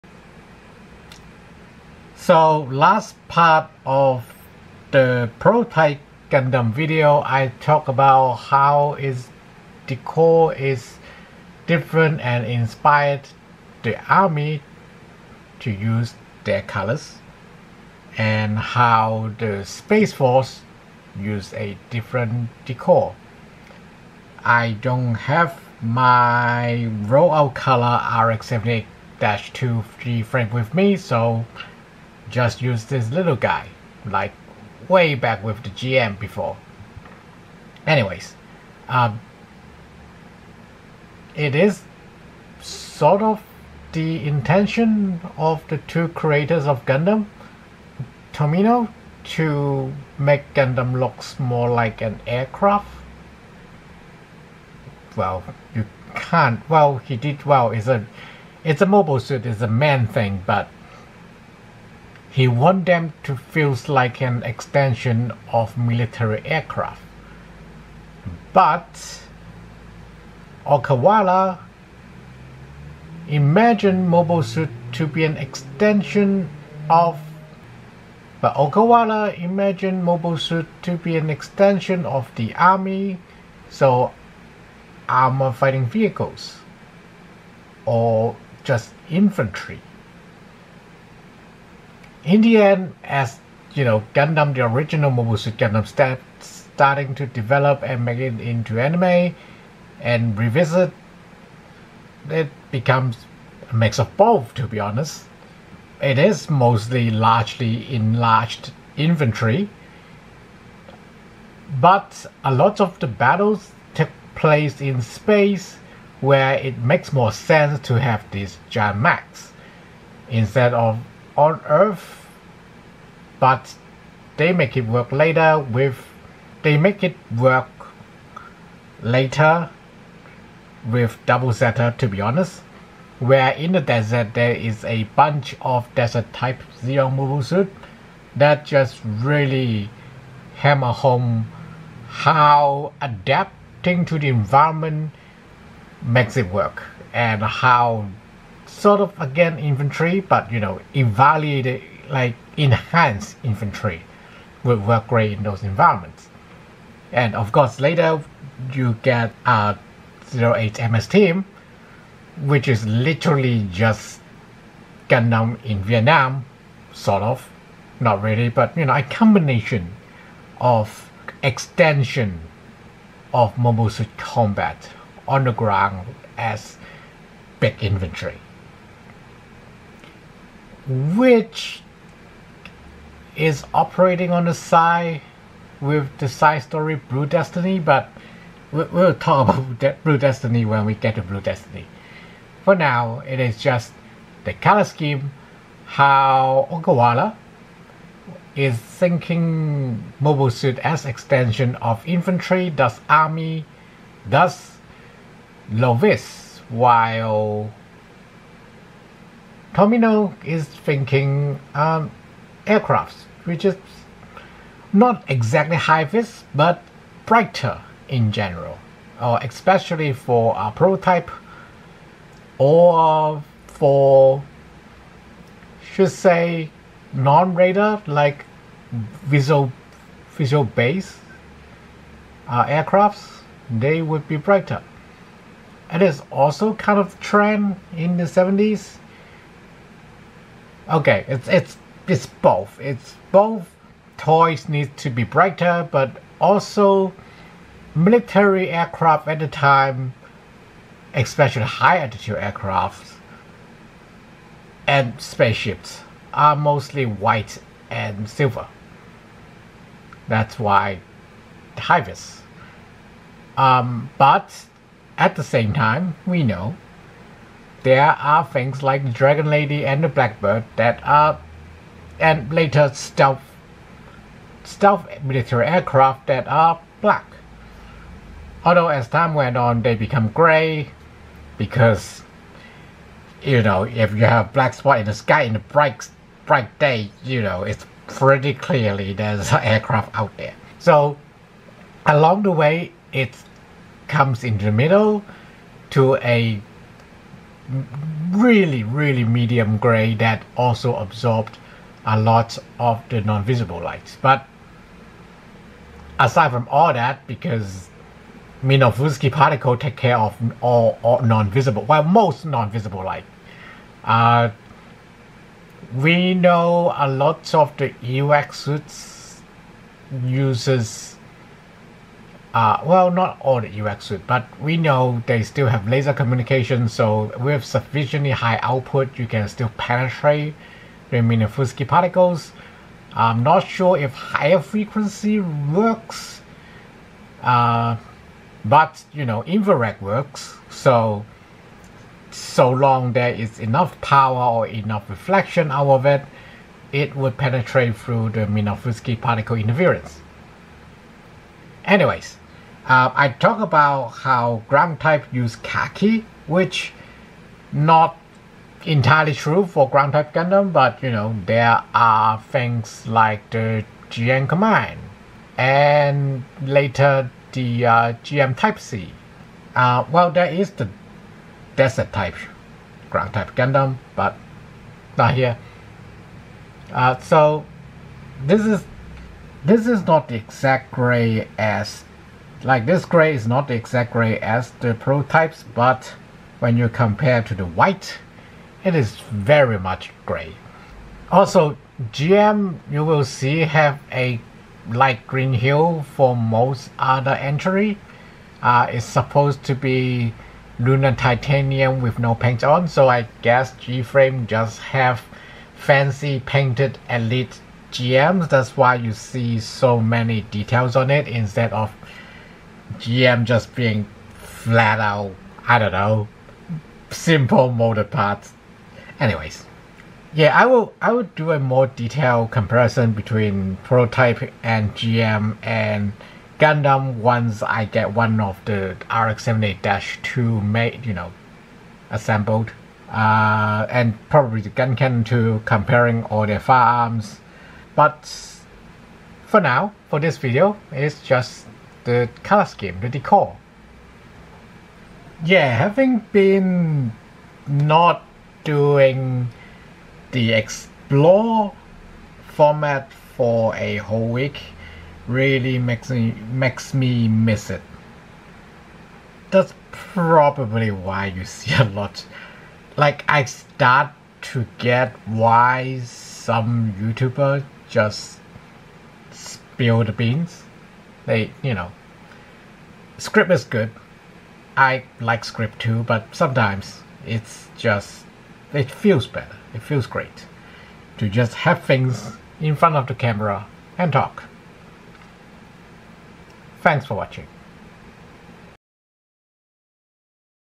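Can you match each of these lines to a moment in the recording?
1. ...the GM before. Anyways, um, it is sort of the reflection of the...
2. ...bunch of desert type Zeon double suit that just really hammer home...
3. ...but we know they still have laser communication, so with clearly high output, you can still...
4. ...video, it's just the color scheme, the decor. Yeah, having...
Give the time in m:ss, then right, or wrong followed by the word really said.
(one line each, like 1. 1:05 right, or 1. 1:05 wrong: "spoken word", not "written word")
1. 0:35 wrong: "intention", not "reflection"
2. 2:15 wrong: "mobile", not "double"
3. 5:24 wrong: "sufficiently", not "clearly"
4. 7:20 right.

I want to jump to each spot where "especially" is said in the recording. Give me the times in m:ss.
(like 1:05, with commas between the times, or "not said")
3:39, 4:11.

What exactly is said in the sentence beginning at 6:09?
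Uh, well, there is the desert type ground type Gundam, but not here.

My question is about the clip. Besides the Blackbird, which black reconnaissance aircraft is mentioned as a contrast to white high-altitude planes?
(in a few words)
Dragon Lady.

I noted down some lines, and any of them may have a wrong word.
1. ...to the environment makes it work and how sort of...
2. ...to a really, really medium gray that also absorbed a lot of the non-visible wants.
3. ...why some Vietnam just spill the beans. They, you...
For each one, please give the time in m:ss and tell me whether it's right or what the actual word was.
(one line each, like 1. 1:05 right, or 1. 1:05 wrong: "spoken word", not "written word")
1. 2:24 right
2. 4:55 wrong: "lights", not "wants"
3. 7:45 wrong: "YouTuber", not "Vietnam".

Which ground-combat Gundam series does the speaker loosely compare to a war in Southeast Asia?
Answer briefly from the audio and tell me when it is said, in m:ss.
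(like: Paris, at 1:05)
08 MS Team, at 2:40.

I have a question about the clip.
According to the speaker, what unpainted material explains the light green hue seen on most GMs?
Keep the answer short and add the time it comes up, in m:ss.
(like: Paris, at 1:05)
lunar titanium, at 6:40.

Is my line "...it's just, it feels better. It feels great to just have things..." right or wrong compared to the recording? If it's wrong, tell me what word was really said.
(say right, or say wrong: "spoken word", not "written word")
right.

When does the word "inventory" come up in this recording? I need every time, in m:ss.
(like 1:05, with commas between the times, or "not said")
1:48, 2:57.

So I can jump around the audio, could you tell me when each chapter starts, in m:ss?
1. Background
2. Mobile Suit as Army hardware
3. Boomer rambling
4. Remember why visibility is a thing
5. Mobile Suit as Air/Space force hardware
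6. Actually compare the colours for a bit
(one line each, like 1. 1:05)
1. 0:39
2. 2:00
3. 7:00
4. 5:05
5. 3:12
6. 5:51.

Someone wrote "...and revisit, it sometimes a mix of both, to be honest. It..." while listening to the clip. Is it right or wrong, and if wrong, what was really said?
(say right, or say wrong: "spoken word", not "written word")
wrong: "becomes", not "sometimes".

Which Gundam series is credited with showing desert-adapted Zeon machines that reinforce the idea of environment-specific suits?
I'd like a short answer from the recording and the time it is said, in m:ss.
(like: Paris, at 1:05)
Double Zeta, at 2:11.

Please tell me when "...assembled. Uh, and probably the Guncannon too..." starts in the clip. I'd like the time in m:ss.
7:12.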